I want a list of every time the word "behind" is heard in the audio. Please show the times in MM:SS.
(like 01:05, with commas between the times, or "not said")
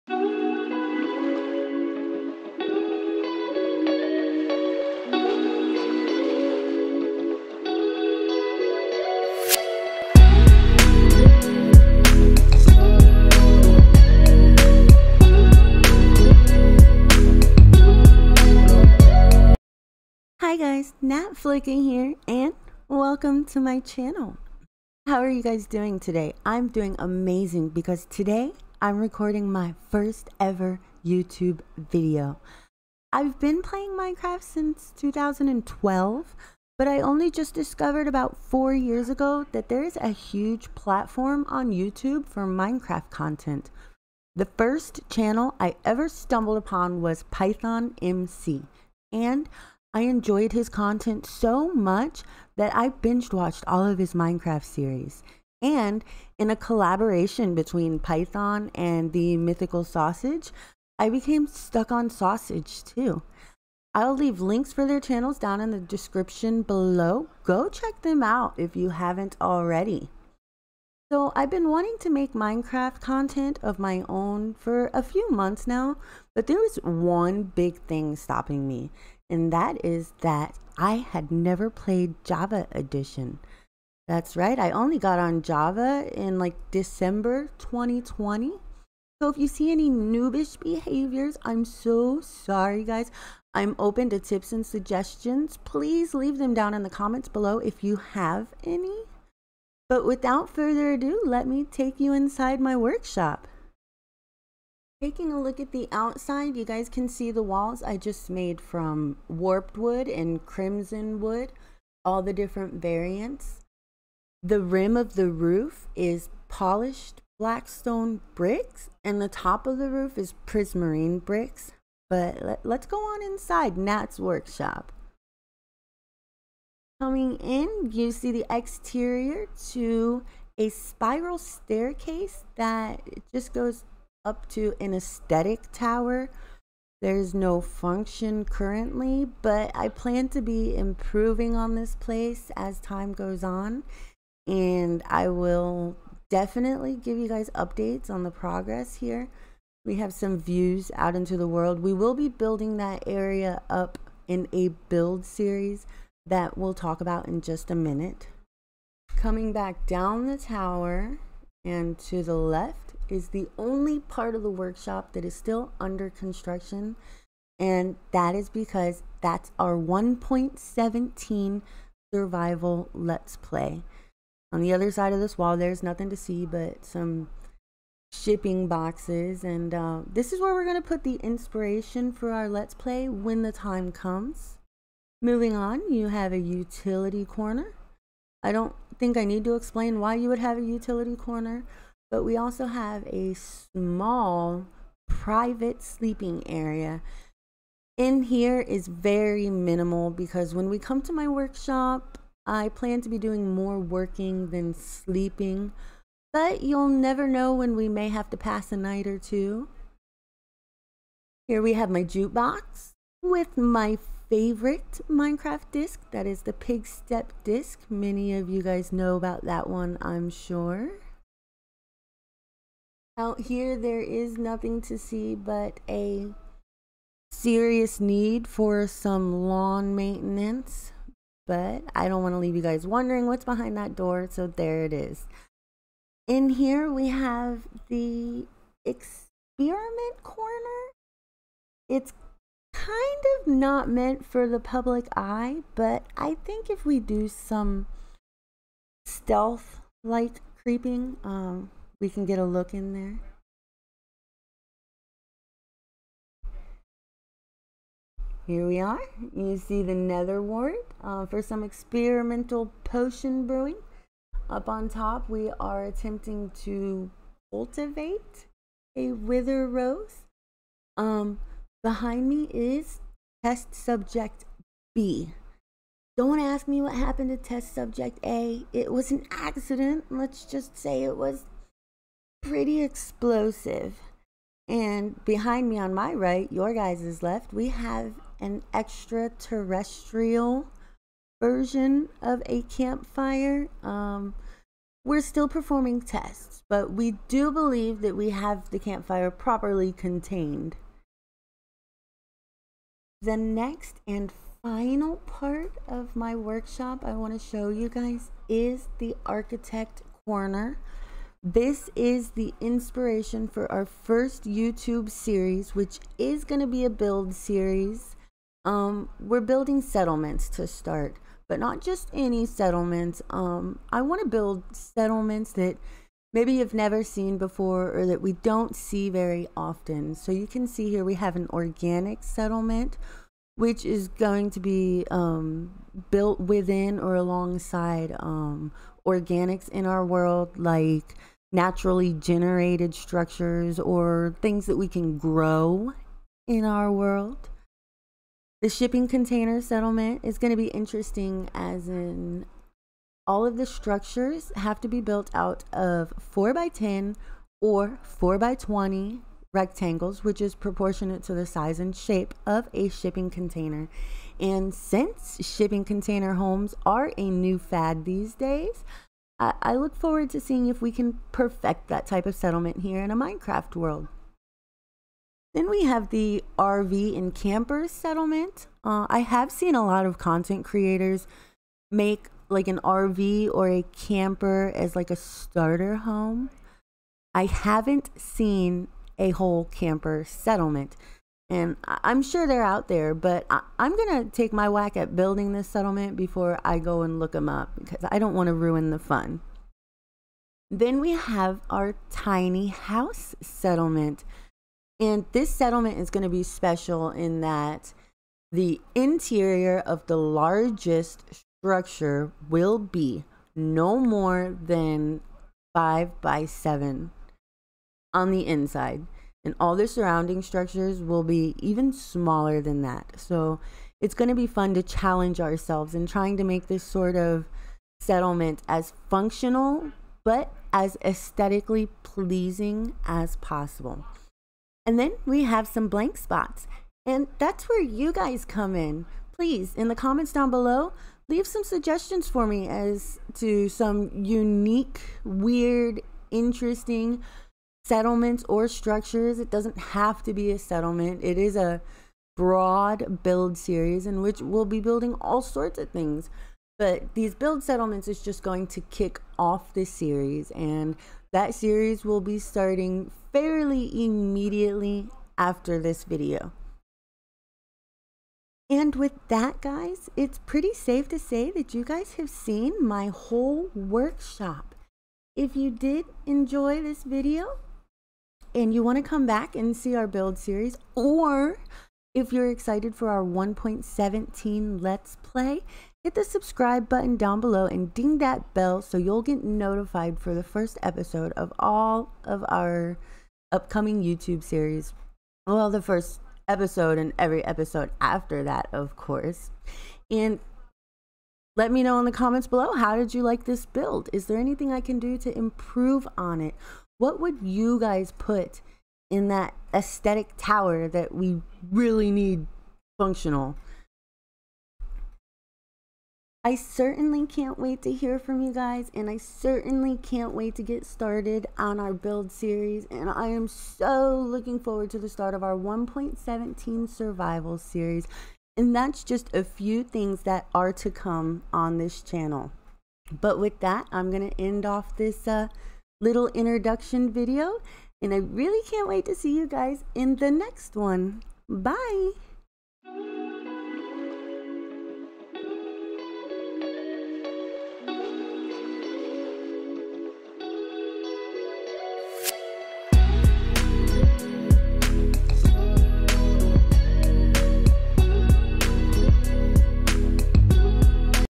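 03:53, 04:31, 04:45.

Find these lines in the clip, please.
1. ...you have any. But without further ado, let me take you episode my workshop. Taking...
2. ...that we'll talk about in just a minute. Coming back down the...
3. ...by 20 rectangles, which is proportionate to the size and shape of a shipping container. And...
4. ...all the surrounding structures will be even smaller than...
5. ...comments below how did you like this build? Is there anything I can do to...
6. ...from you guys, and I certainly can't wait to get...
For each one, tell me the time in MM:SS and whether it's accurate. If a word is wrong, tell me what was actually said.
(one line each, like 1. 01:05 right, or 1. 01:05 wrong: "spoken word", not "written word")
1. 01:37 wrong: "inside", not "episode"
2. 02:36 right
3. 05:58 right
4. 06:59 right
5. 08:22 right
6. 08:38 right.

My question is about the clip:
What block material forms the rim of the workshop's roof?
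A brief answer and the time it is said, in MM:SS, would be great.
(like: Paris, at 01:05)
Polished blackstone bricks, at 01:56.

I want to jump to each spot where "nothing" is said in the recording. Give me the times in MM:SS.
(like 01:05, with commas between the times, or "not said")
02:55, 03:44.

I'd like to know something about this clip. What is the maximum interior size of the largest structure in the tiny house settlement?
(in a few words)
5 by 7.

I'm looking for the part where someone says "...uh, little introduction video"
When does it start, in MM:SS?
08:55.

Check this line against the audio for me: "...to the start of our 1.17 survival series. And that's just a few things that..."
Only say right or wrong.
right.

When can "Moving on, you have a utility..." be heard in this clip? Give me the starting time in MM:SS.
03:05.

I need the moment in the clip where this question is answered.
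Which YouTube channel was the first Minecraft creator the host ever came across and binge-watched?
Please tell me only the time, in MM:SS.
00:47.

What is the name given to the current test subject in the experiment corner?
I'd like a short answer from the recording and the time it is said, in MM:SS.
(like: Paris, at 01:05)
Test subject B, at 04:33.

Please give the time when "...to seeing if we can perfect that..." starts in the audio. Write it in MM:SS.
06:10.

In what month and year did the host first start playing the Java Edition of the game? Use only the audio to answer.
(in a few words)
December 2020.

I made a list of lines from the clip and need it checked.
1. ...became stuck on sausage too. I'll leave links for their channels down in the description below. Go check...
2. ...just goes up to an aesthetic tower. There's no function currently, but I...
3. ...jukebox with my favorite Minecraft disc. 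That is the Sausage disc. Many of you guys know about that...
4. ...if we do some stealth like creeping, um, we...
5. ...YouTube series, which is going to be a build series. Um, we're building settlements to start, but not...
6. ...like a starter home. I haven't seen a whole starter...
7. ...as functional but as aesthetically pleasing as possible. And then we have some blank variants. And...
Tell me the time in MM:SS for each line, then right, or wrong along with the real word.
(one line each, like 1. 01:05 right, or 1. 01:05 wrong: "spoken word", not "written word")
1. 01:01 right
2. 02:13 right
3. 03:32 wrong: "Pigstep", not "Sausage"
4. 04:06 right
5. 05:14 right
6. 06:24 wrong: "camper", not "starter"
7. 07:08 wrong: "spots", not "variants".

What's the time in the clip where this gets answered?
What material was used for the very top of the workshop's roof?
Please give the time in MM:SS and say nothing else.
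02:00.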